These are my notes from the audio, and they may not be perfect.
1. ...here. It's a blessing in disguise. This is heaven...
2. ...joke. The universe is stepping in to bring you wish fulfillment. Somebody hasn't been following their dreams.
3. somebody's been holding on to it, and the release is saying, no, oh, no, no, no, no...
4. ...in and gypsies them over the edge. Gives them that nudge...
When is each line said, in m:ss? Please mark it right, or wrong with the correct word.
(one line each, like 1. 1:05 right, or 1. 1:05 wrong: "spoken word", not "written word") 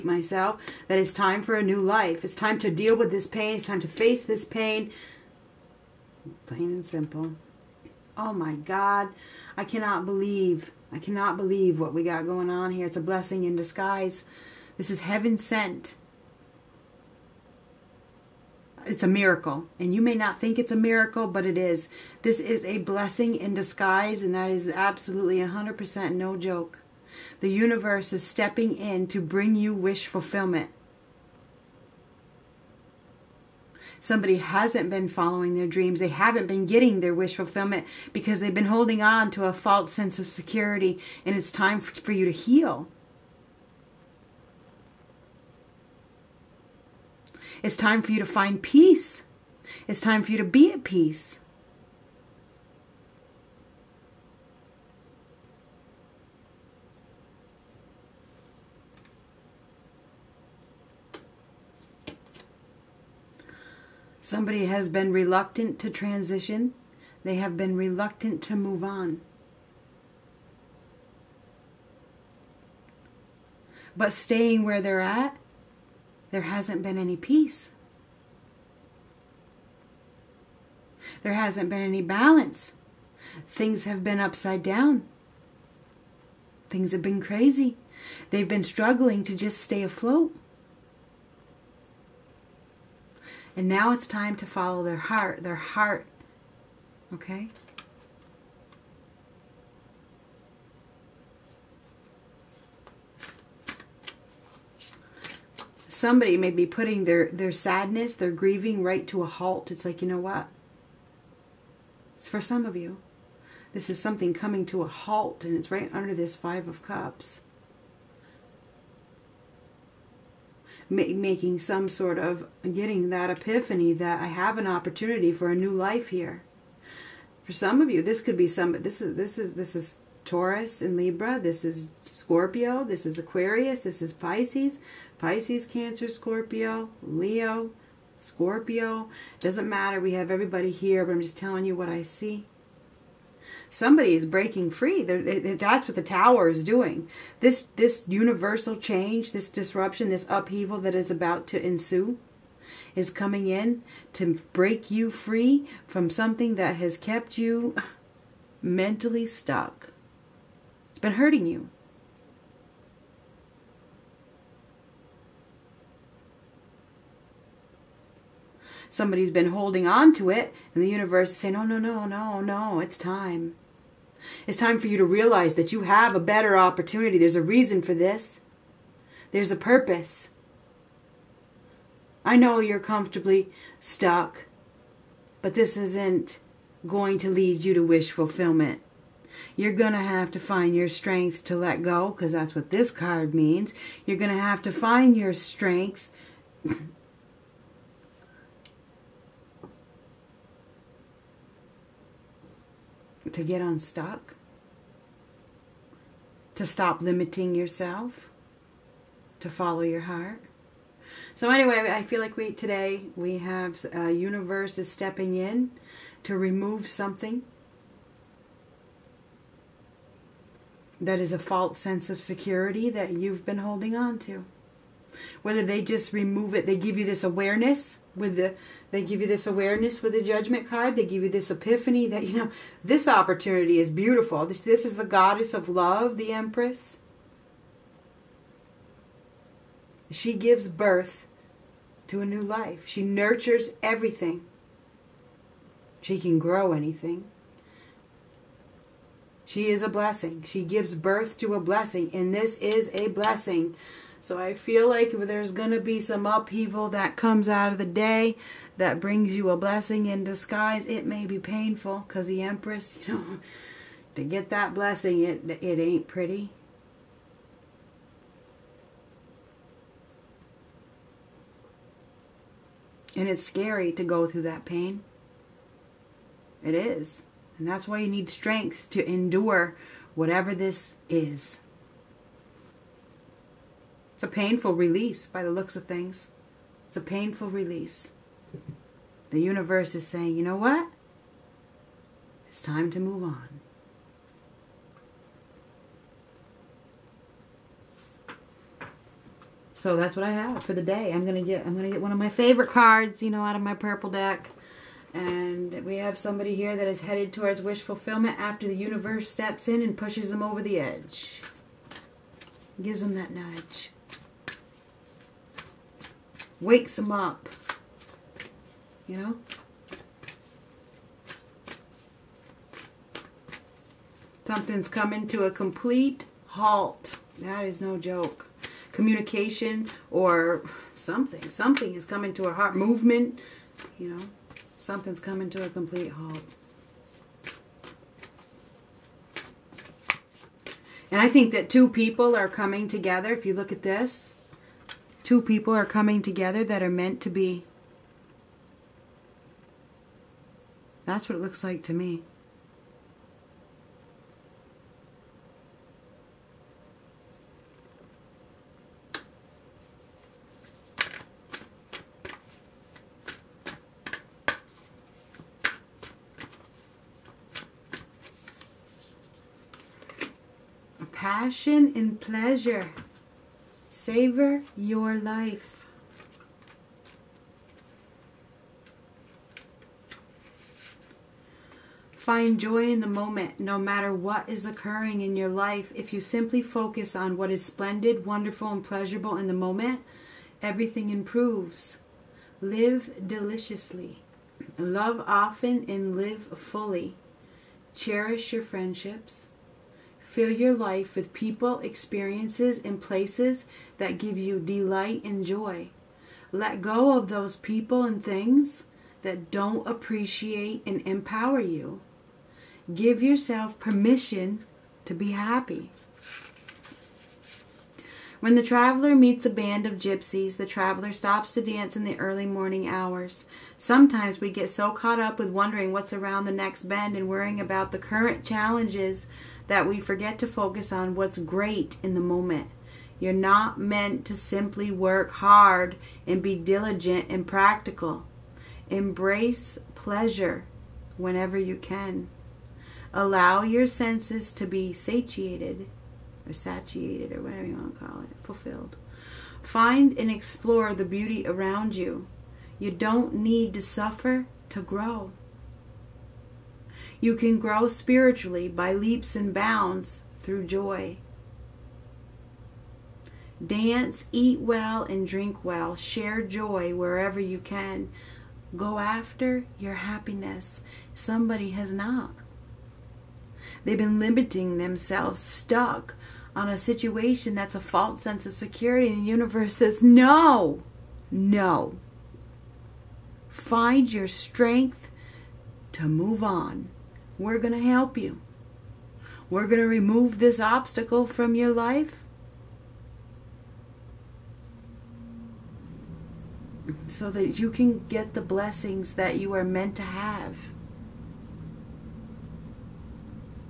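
1. 0:12 right
2. 0:26 right
3. 2:48 wrong: "universe", not "release"
4. 5:09 wrong: "pushes", not "gypsies".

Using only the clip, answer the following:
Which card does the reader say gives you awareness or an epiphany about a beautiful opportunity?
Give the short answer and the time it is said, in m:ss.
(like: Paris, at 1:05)
Judgment, at 3:50.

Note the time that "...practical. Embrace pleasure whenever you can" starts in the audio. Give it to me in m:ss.
7:17.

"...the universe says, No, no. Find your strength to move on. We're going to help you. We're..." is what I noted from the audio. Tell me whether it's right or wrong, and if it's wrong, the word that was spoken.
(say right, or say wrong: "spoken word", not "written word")
right.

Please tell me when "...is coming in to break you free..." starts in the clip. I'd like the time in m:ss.
2:32.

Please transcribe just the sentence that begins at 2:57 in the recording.
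There's a reason for this, there's a purpose.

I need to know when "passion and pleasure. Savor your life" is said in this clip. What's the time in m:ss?
6:11.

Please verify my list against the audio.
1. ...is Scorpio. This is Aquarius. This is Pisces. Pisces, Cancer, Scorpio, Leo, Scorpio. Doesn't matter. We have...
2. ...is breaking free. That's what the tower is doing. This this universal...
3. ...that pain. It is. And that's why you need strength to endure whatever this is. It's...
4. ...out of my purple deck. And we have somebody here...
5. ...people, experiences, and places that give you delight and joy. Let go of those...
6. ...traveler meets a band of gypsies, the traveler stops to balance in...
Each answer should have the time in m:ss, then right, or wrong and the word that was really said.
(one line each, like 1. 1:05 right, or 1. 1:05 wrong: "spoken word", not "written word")
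1. 2:11 right
2. 2:24 right
3. 4:34 right
4. 5:03 right
5. 6:41 right
6. 6:58 wrong: "dance", not "balance".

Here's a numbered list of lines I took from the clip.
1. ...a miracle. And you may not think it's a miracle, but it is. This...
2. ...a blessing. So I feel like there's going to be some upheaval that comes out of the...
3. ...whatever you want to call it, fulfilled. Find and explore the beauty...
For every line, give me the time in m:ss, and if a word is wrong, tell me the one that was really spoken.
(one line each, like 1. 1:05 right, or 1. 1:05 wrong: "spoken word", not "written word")
1. 0:19 right
2. 4:12 right
3. 7:27 right.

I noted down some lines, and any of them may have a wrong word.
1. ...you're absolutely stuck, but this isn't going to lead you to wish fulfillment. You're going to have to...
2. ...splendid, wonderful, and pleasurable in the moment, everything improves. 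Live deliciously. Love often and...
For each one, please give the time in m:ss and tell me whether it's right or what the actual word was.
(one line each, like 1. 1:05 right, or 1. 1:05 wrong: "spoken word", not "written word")
1. 3:02 wrong: "comfortably", not "absolutely"
2. 6:27 right.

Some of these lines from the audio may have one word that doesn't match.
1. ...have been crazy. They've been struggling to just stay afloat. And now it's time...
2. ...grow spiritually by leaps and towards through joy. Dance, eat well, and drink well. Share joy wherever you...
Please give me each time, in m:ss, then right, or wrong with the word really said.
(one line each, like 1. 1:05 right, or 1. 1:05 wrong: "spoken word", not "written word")
1. 1:26 right
2. 7:37 wrong: "bounds", not "towards".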